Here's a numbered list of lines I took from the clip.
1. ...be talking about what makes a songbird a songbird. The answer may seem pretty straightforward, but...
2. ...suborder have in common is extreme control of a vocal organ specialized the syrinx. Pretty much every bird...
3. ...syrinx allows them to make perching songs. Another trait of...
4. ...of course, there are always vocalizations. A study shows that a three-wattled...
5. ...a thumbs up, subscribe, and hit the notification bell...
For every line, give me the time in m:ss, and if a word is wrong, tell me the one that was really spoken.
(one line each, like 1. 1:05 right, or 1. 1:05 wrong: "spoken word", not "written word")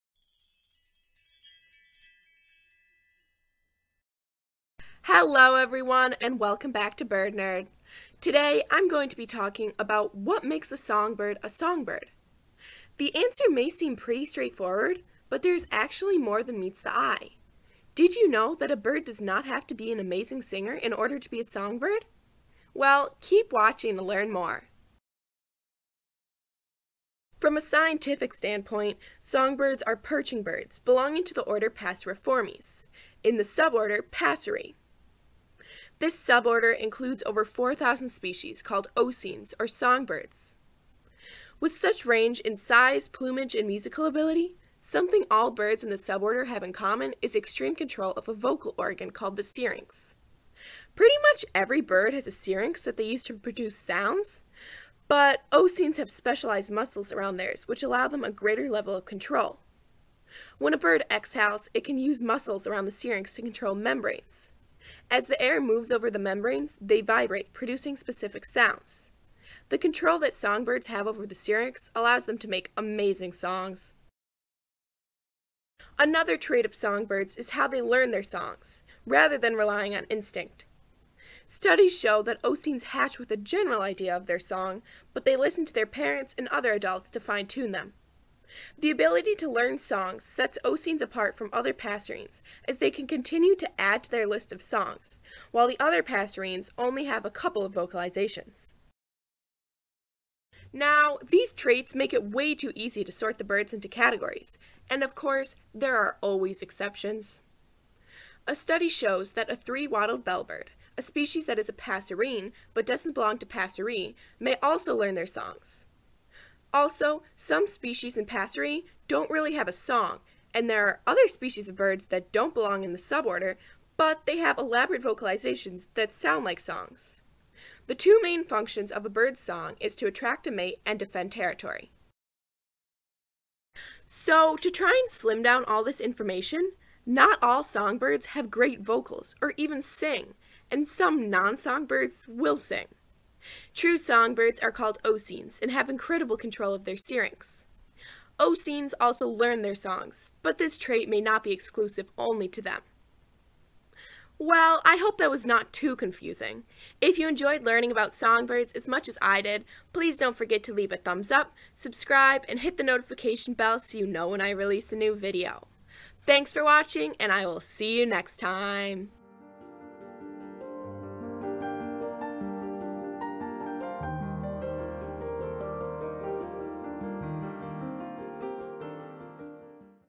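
1. 0:09 right
2. 0:45 wrong: "called", not "specialized"
3. 1:11 wrong: "amazing", not "perching"
4. 1:45 wrong: "exceptions", not "vocalizations"
5. 2:40 right.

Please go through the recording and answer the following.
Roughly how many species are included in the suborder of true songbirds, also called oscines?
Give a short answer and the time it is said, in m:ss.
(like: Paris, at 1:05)
over 4,000, at 0:37.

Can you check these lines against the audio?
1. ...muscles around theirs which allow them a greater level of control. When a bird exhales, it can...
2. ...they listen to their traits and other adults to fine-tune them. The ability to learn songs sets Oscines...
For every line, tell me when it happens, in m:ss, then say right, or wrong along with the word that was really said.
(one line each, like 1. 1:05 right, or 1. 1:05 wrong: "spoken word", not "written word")
1. 0:56 right
2. 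1:25 wrong: "parents", not "traits".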